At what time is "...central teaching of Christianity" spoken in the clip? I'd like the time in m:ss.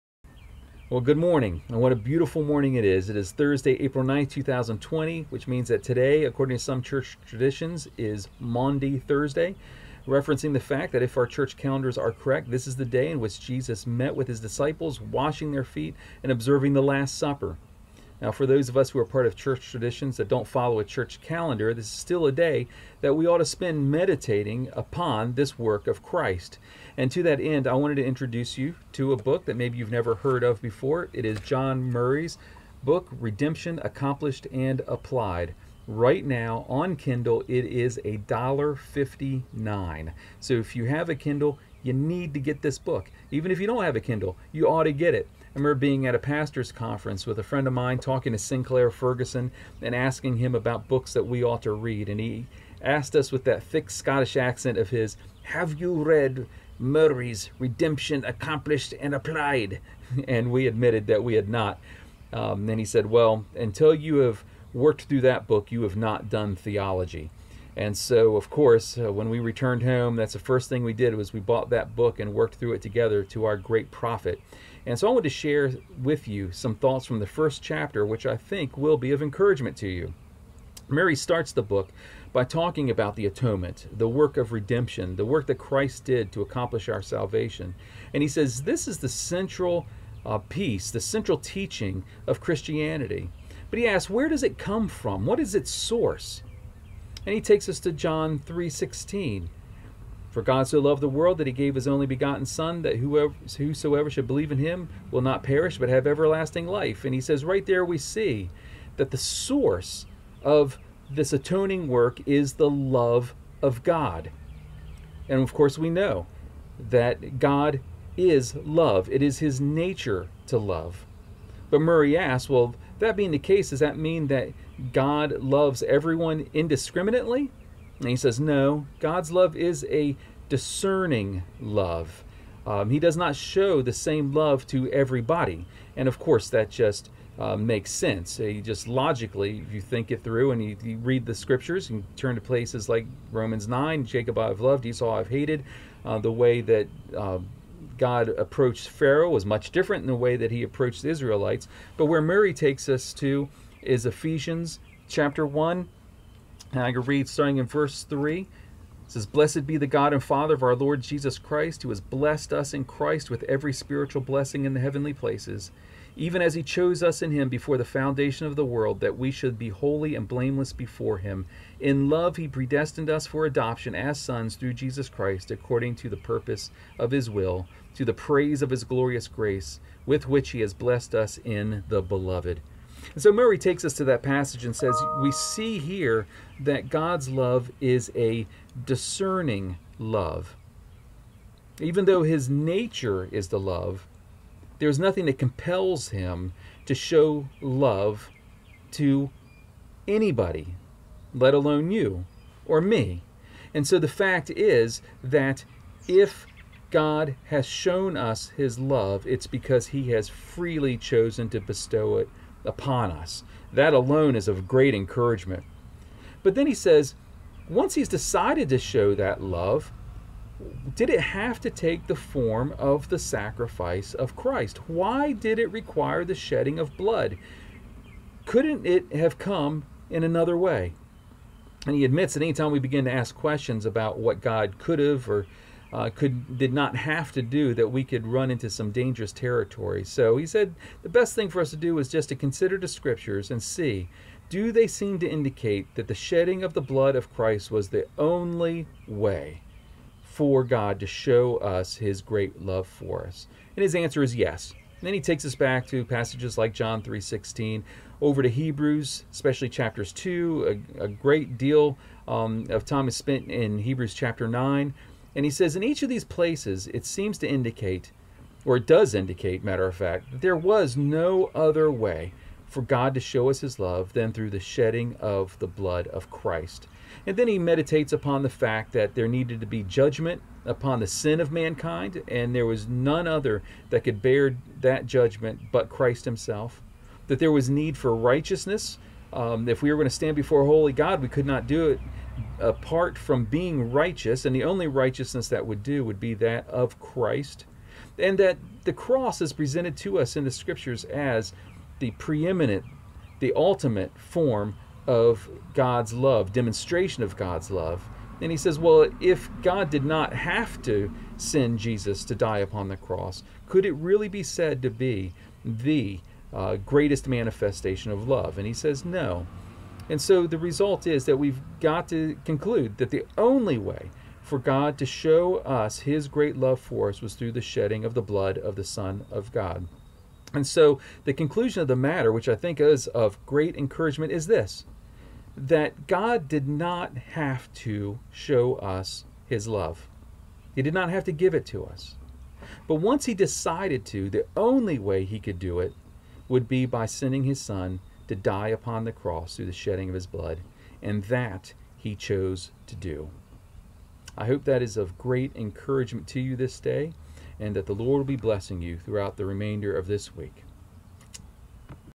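1:30.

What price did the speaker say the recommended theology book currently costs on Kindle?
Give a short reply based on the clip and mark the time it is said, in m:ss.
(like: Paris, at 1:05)
$1.59, at 0:38.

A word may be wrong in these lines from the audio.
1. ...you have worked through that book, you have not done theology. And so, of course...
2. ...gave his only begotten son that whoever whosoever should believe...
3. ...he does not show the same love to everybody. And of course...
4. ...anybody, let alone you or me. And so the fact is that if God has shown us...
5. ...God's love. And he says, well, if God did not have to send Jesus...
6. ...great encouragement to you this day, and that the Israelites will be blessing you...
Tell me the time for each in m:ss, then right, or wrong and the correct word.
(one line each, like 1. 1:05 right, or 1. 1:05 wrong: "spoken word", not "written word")
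1. 1:03 right
2. 1:41 right
3. 2:12 right
4. 3:20 right
5. 5:07 right
6. 5:55 wrong: "Lord", not "Israelites".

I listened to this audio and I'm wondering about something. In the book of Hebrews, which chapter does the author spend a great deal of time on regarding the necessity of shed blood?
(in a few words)
Chapter 9.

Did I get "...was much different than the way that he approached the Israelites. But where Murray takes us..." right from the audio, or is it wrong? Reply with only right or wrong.
right.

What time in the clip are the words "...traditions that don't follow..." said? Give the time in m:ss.
0:19.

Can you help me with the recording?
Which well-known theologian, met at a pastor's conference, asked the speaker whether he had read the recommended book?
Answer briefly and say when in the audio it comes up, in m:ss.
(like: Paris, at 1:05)
Sinclair Ferguson, at 0:48.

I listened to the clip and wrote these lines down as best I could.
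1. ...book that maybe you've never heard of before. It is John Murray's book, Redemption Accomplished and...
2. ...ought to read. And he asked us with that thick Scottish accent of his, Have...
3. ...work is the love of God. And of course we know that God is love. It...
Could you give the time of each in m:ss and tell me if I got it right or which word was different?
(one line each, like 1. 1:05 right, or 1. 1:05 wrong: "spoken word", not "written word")
1. 0:29 right
2. 0:51 right
3. 1:51 right.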